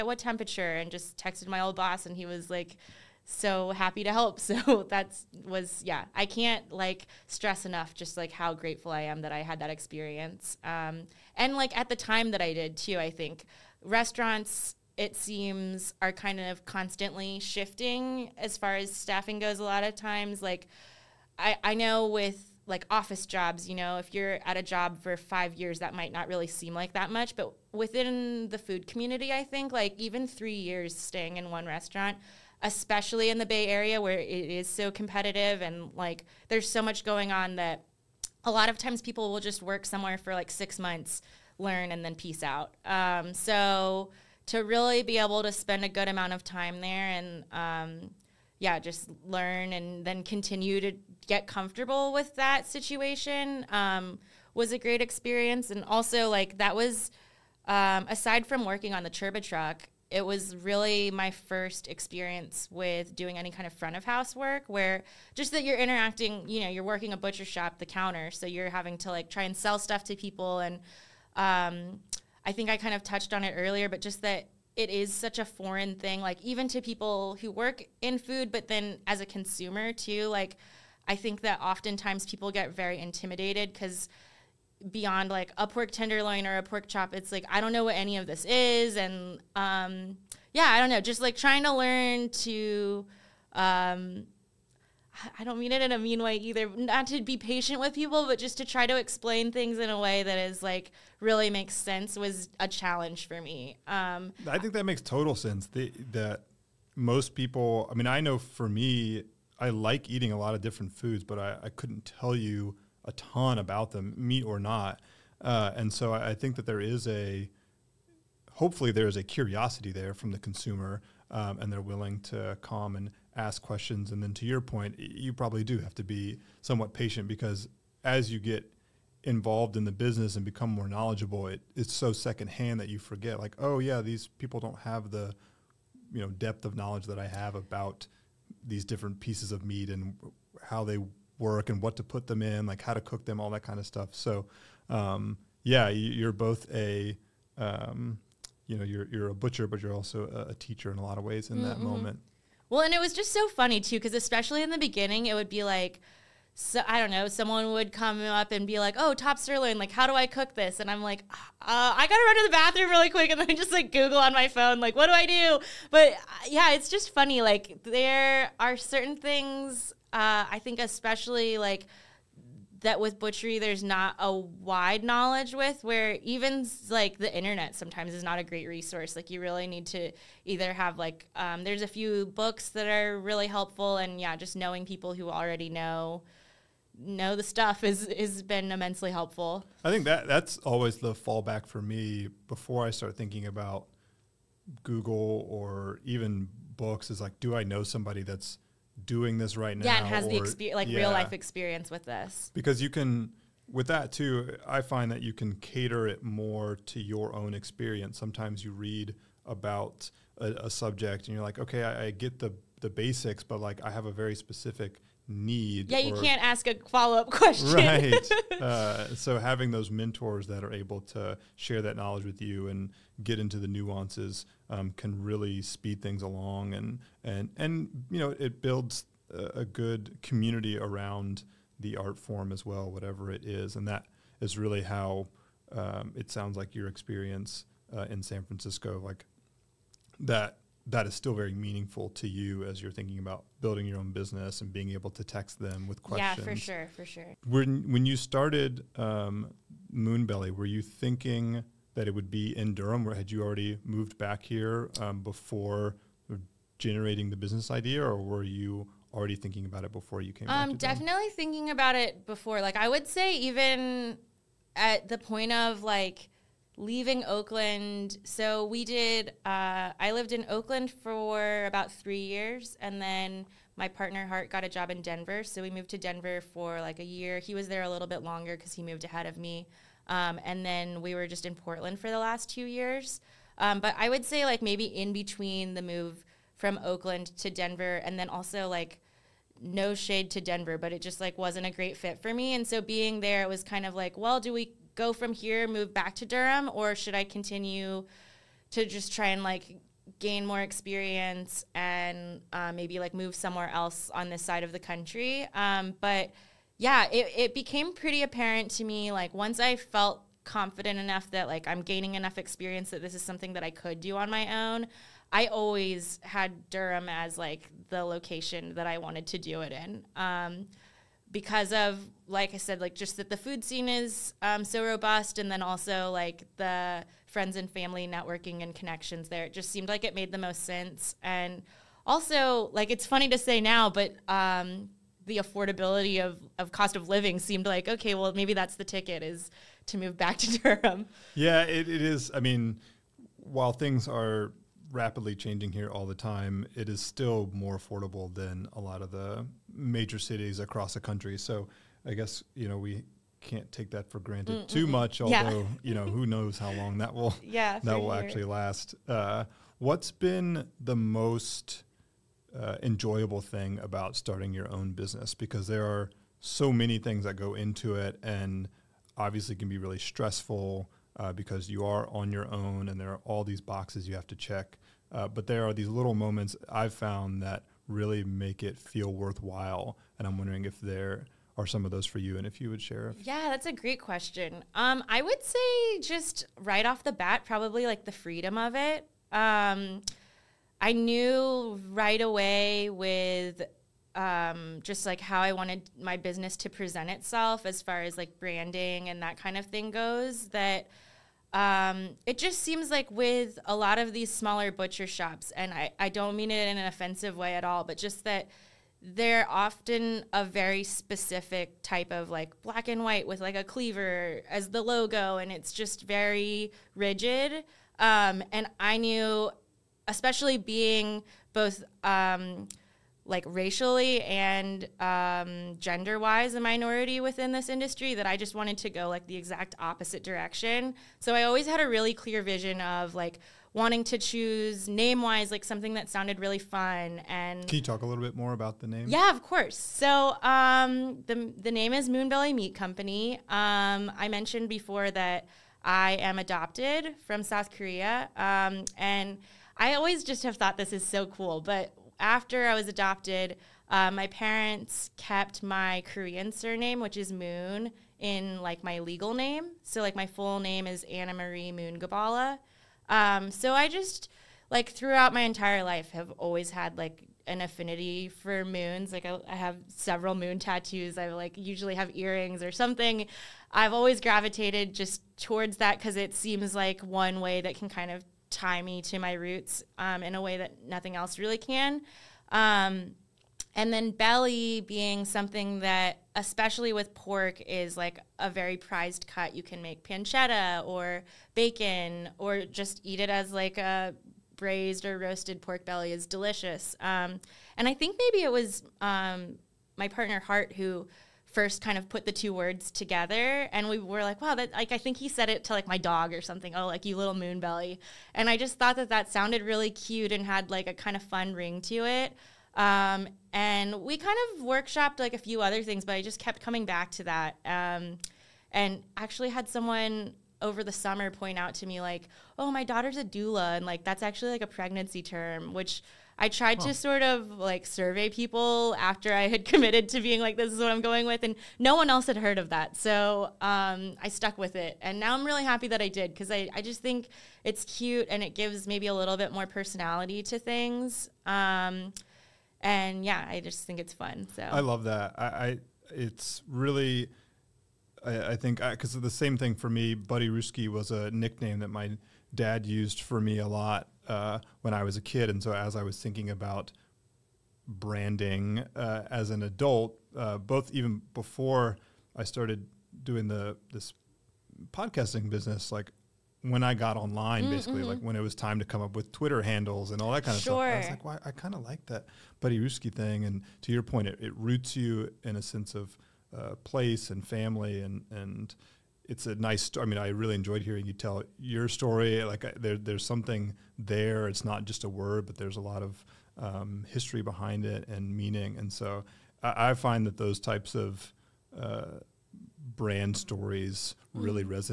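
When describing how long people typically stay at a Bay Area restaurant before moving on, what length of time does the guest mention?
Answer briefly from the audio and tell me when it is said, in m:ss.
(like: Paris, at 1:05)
6 months, at 0:40.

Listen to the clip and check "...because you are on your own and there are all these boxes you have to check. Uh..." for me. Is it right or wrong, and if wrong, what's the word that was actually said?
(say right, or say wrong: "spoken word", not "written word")
right.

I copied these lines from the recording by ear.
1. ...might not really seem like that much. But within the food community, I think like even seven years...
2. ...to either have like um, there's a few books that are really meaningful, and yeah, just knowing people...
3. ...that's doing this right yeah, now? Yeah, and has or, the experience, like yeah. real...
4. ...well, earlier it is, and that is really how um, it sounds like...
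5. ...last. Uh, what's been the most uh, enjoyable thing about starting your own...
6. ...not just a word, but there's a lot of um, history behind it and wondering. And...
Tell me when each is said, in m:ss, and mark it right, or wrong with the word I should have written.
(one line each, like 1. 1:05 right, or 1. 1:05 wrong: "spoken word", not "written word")
1. 0:25 wrong: "three", not "seven"
2. 2:59 wrong: "helpful", not "meaningful"
3. 3:18 right
4. 3:52 wrong: "whatever", not "earlier"
5. 5:58 right
6. 9:44 wrong: "meaning", not "wondering".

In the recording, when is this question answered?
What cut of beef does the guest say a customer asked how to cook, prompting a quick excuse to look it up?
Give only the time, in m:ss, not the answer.
2:39.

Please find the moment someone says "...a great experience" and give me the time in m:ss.
0:54.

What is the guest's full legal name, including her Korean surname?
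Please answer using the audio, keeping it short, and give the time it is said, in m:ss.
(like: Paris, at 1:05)
Anna Marie Moon Gibala, at 7:41.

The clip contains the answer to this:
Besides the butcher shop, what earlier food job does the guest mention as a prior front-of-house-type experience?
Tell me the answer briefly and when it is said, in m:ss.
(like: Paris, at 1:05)
Turbo Truck, at 0:59.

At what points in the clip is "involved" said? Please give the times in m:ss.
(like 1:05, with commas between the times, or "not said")
2:09.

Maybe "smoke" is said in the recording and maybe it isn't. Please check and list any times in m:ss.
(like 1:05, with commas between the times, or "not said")
not said.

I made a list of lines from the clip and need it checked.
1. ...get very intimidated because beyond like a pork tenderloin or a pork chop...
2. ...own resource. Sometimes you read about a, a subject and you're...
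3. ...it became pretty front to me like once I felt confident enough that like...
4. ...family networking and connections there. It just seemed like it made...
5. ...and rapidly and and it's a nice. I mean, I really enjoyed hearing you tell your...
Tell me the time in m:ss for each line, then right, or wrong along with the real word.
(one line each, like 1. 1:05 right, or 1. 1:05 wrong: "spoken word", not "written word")
1. 1:22 right
2. 3:27 wrong: "experience", not "resource"
3. 5:07 wrong: "apparent", not "front"
4. 5:27 right
5. 9:37 wrong: "family", not "rapidly".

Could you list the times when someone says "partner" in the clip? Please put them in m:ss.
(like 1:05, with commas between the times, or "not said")
4:33, 8:20.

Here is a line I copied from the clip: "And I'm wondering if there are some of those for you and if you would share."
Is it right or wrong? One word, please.
right.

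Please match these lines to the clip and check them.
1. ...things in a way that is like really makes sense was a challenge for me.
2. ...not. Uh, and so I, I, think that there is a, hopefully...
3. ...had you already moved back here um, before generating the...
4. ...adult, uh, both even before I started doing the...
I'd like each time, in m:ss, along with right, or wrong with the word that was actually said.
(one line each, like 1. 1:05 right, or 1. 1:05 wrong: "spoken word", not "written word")
1. 1:39 right
2. 1:54 right
3. 4:13 right
4. 9:19 right.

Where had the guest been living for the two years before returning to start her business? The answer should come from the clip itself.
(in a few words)
Portland.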